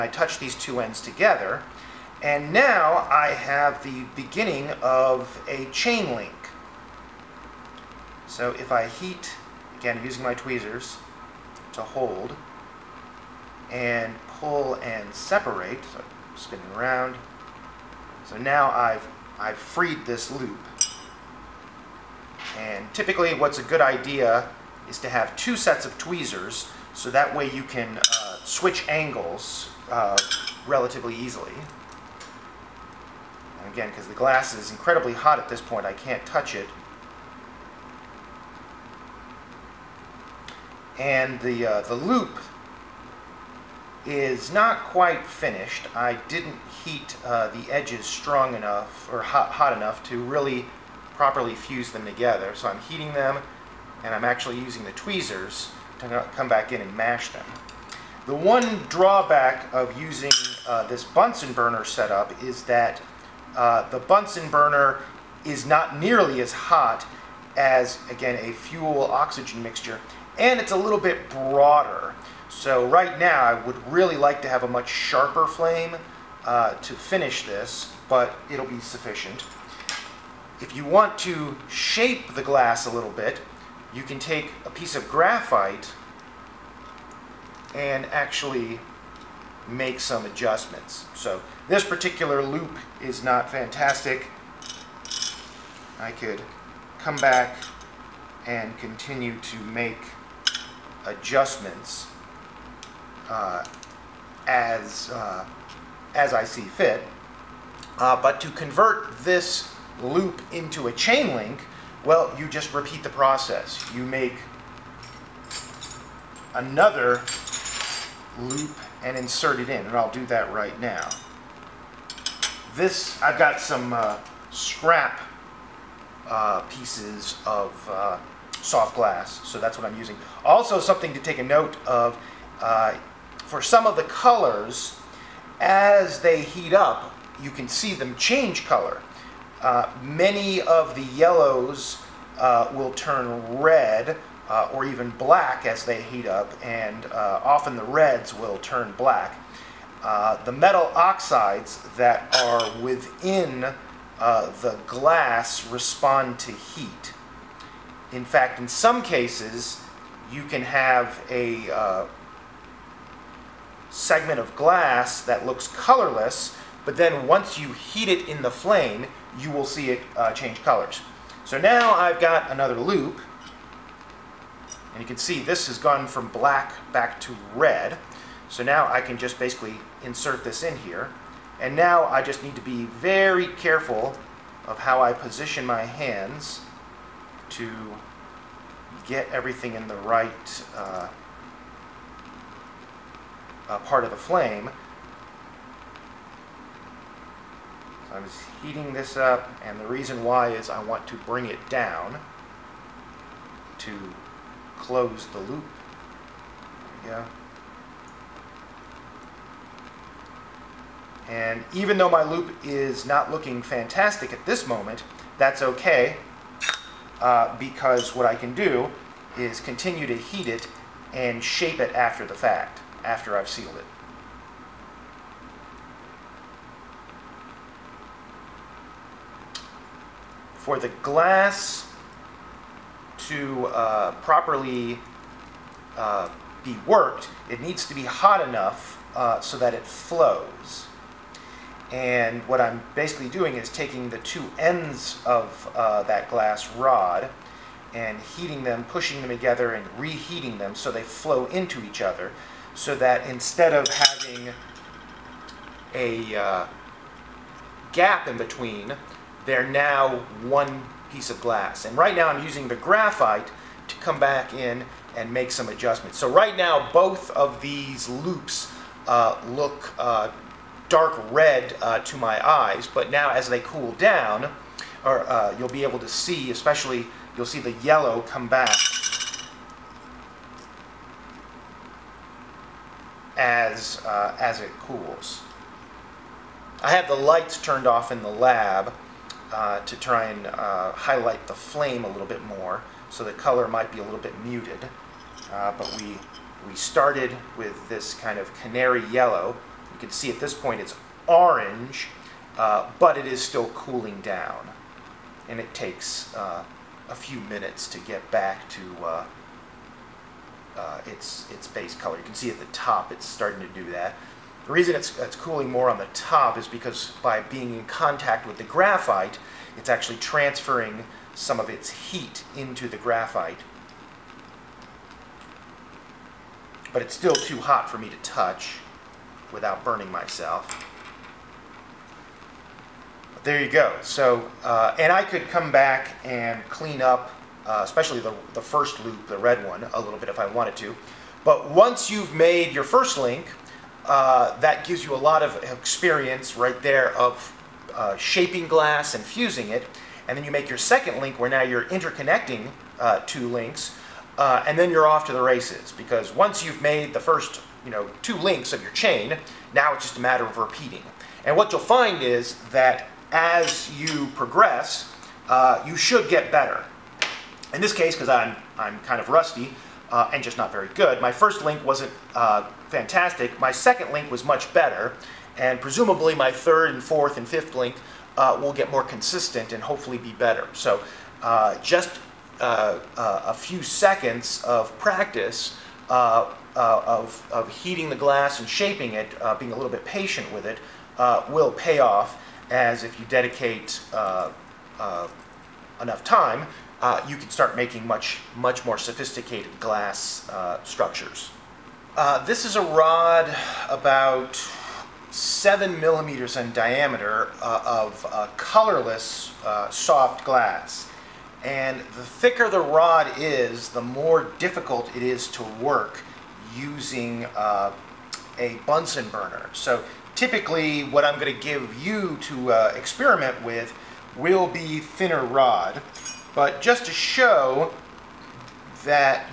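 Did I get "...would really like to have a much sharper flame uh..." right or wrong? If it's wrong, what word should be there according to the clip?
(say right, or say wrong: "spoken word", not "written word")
right.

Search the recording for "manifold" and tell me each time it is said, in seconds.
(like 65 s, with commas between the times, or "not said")
not said.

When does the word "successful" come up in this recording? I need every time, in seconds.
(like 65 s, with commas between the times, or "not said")
not said.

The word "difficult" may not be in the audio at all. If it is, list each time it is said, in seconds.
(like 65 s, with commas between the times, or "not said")
414 s.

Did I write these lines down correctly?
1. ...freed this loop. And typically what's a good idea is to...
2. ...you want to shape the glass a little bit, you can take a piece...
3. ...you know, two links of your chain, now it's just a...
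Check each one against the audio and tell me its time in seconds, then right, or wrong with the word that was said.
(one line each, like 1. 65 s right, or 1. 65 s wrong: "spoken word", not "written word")
1. 19 s right
2. 80 s right
3. 357 s right.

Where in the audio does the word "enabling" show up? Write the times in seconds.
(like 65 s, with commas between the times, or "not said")
not said.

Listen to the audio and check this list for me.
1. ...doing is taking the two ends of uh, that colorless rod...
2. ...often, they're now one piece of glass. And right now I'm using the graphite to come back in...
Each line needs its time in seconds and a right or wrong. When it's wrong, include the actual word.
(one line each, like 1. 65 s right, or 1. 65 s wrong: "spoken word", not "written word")
1. 243 s wrong: "glass", not "colorless"
2. 258 s wrong: "between", not "often".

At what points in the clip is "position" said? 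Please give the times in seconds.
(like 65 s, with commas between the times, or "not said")
185 s.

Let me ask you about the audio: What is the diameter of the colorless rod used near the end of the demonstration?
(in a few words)
7 millimeters.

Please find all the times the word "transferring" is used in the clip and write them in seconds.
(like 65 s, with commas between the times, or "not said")
320 s.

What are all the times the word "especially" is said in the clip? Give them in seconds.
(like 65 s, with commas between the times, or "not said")
276 s, 337 s.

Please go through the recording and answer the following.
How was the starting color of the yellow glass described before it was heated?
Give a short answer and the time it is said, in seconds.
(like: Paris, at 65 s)
Canary yellow, at 298 s.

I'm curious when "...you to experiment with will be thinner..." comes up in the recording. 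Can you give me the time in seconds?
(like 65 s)
422 s.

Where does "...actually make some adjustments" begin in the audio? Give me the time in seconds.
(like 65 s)
88 s.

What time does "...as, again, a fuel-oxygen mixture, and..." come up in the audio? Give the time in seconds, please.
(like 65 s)
67 s.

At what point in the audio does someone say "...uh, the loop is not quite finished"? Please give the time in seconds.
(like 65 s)
41 s.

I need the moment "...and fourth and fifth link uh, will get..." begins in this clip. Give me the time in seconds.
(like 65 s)
376 s.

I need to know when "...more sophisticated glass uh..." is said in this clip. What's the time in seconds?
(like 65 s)
398 s.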